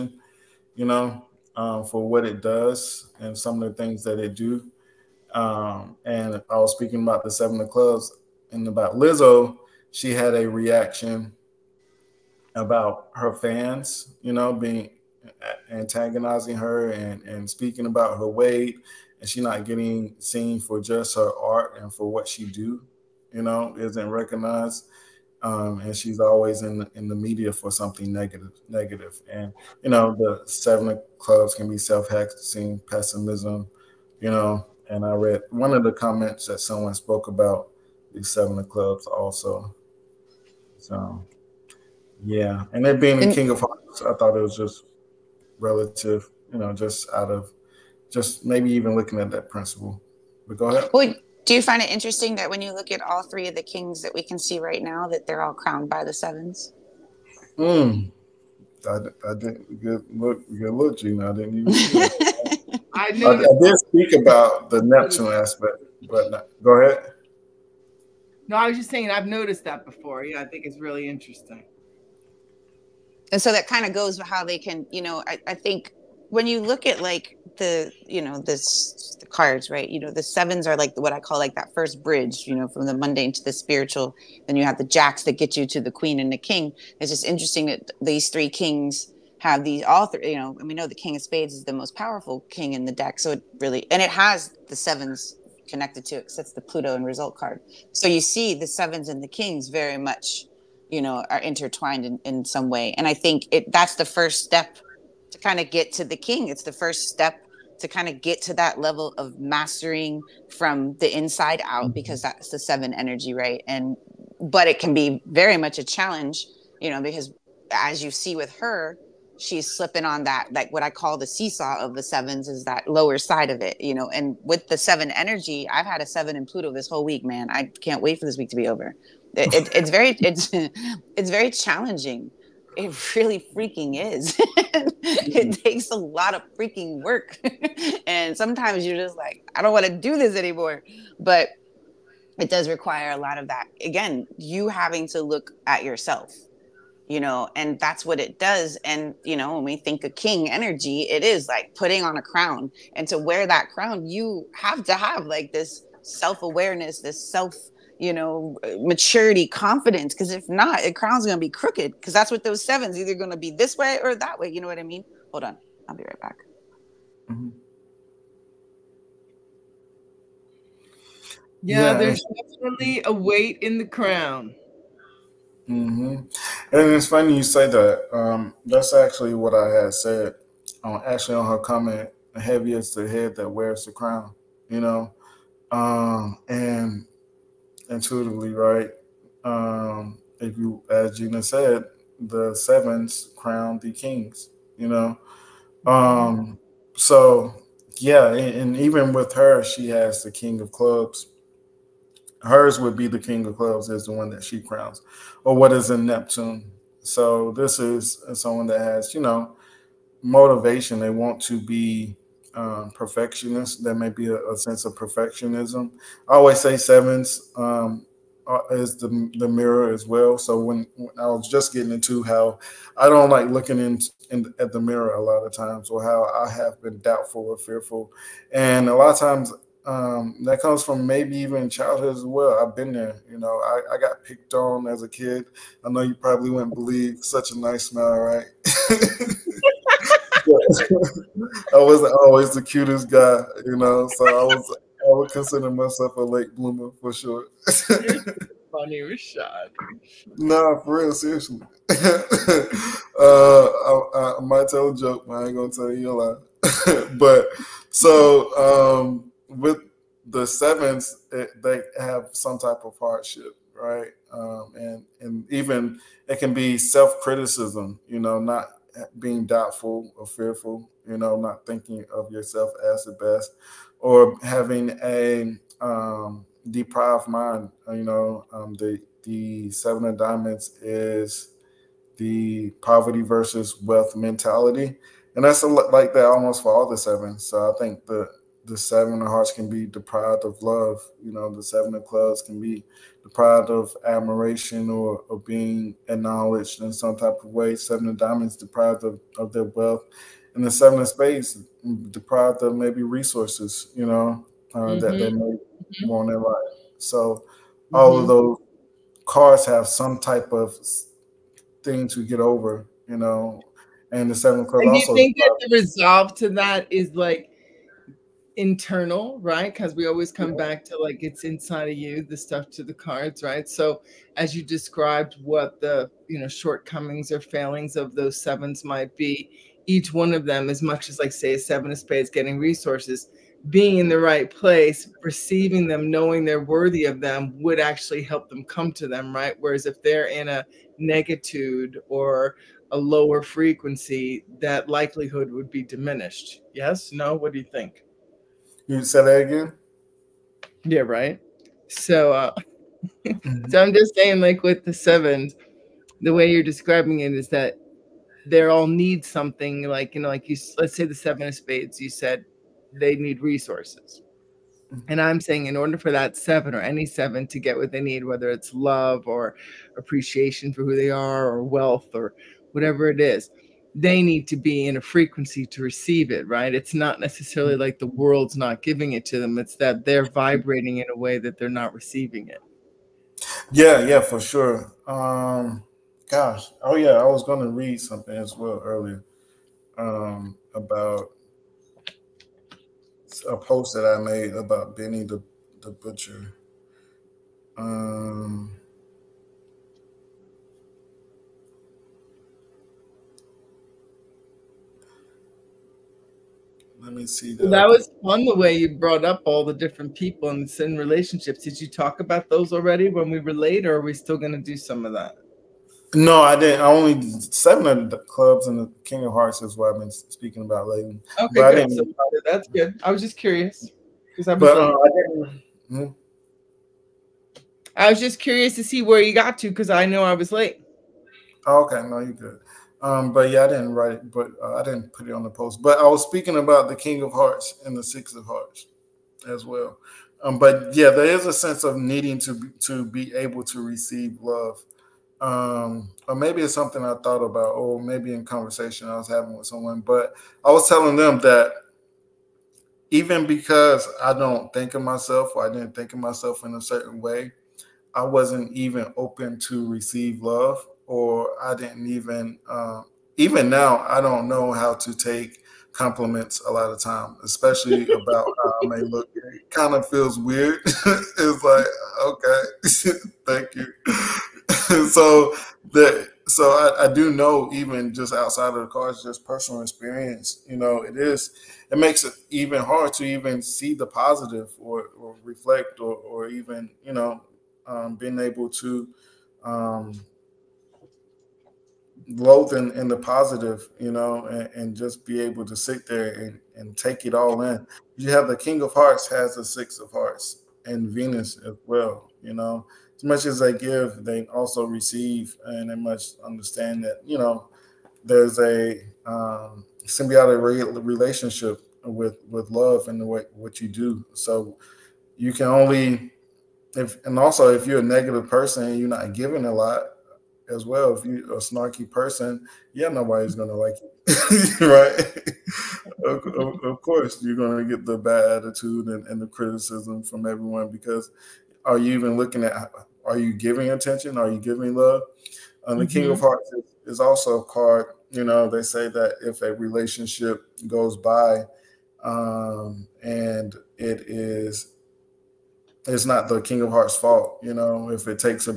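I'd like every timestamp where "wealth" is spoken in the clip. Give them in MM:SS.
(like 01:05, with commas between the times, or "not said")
04:43, 04:59, 06:11.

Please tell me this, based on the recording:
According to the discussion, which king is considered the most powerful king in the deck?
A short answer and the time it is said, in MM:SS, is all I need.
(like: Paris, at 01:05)
King of Spades, at 01:30.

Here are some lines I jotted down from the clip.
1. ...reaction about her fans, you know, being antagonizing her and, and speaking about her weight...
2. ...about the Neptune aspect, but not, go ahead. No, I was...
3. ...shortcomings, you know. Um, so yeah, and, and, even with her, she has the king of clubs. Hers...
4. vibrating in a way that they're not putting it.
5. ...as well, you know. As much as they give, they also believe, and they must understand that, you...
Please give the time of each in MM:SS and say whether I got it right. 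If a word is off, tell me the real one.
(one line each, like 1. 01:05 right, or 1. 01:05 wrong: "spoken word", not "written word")
1. 00:10 right
2. 01:04 right
3. 03:13 wrong: "kings", not "shortcomings"
4. 06:20 wrong: "receiving", not "putting"
5. 08:21 wrong: "receive", not "believe".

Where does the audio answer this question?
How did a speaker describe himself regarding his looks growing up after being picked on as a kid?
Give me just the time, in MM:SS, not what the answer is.
04:06.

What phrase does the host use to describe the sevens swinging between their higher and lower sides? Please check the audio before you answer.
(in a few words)
the seesaw of the sevens.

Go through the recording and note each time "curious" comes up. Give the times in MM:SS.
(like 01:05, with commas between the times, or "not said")
07:03, 07:08.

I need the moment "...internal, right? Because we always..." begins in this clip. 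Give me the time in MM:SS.
05:18.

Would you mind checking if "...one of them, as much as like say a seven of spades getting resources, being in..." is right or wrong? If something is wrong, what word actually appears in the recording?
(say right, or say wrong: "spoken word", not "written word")
right.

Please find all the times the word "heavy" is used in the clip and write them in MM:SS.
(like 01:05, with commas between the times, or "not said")
03:02.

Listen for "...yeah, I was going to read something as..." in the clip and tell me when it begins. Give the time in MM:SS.
06:26.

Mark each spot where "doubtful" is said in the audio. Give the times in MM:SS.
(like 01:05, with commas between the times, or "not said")
03:46, 04:29.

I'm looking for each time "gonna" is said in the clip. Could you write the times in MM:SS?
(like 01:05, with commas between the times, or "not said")
04:15, 08:43, 08:47.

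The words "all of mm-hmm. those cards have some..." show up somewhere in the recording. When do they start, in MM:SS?
05:07.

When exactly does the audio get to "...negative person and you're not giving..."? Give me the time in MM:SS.
08:38.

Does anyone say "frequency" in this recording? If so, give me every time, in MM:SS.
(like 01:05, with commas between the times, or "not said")
05:43, 06:15.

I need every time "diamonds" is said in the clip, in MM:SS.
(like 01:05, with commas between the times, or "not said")
04:40, 04:58.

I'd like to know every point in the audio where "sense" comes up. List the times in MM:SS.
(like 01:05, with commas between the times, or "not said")
03:34, 07:21.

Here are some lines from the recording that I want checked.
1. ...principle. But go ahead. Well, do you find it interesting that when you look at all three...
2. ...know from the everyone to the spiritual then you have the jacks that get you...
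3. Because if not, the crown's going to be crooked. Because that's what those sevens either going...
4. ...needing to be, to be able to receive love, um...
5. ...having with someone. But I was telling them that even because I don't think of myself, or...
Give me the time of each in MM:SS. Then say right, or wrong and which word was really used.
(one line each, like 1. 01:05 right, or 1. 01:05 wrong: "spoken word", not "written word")
1. 00:49 right
2. 01:22 wrong: "mundane", not "everyone"
3. 02:40 right
4. 07:21 right
5. 07:29 right.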